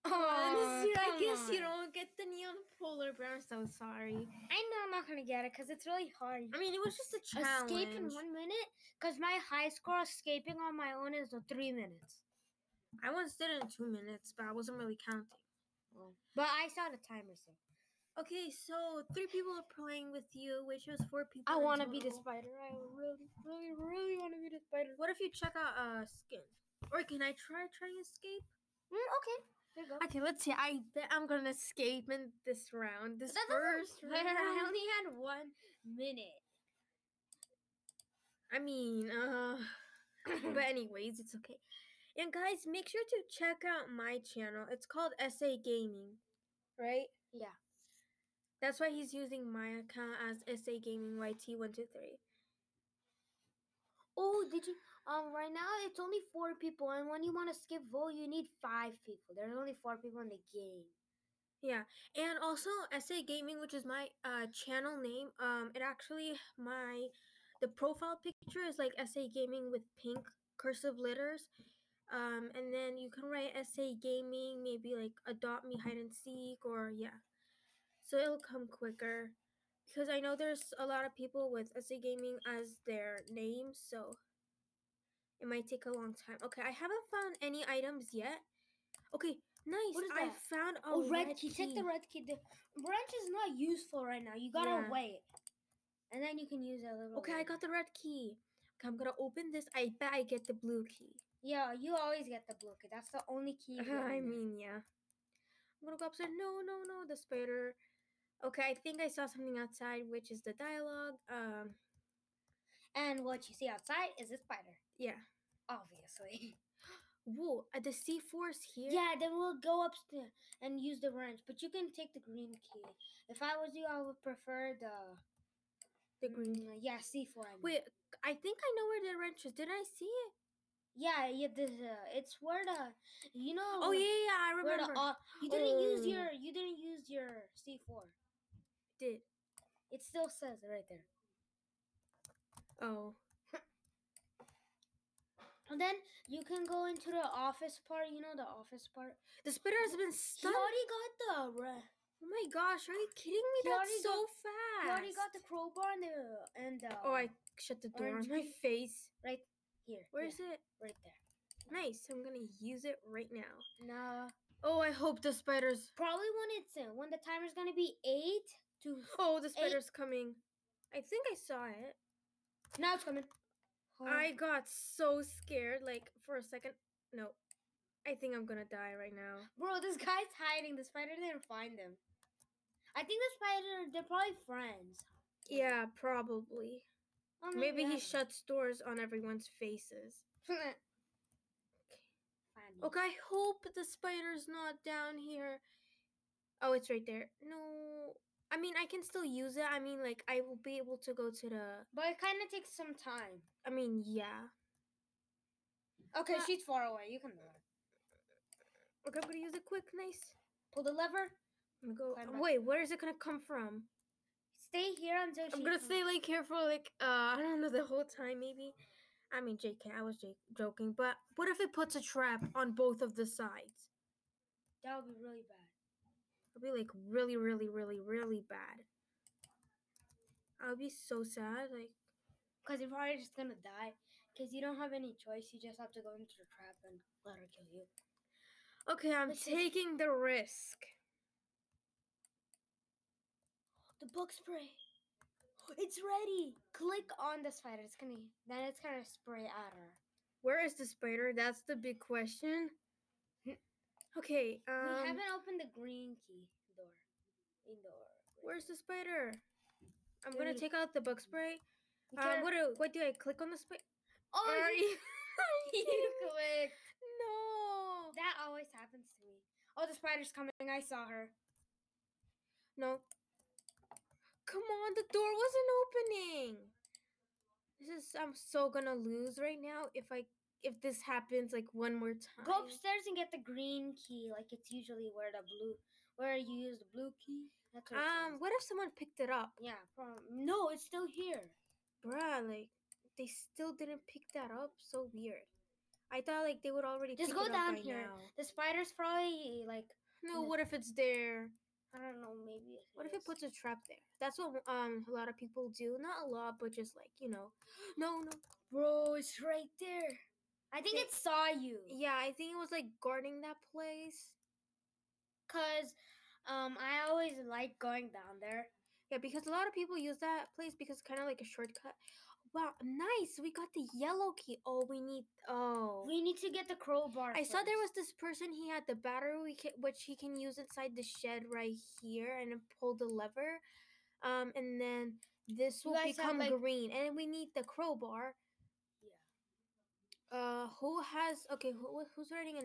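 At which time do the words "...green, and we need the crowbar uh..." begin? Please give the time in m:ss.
5:36.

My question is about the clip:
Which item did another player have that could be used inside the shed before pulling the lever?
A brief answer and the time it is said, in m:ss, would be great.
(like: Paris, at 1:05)
Battery, at 5:28.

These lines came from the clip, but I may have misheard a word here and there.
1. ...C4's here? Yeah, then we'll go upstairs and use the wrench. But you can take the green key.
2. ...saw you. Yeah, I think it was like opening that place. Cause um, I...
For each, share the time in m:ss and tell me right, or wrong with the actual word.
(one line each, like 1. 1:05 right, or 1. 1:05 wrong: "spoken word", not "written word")
1. 1:57 right
2. 5:11 wrong: "guarding", not "opening".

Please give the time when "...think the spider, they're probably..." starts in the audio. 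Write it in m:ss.
3:03.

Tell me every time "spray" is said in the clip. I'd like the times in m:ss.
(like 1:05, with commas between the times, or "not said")
4:04, 4:09, 4:21.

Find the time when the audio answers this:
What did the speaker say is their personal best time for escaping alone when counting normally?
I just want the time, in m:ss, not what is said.
0:11.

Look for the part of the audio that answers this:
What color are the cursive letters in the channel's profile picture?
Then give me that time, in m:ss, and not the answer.
1:09.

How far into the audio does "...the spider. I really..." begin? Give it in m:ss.
0:21.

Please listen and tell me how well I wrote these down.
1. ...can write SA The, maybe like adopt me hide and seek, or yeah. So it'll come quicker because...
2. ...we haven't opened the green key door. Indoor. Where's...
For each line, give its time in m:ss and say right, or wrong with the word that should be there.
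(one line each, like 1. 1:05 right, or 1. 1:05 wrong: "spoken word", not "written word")
1. 1:13 wrong: "Gaming", not "The"
2. 4:15 right.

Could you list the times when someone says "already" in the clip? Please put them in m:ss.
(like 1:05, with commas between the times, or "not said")
2:30, 2:34, 4:56.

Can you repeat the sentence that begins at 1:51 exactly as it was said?
Um, and what you see outside is a spider.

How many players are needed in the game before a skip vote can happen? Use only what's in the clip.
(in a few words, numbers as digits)
5.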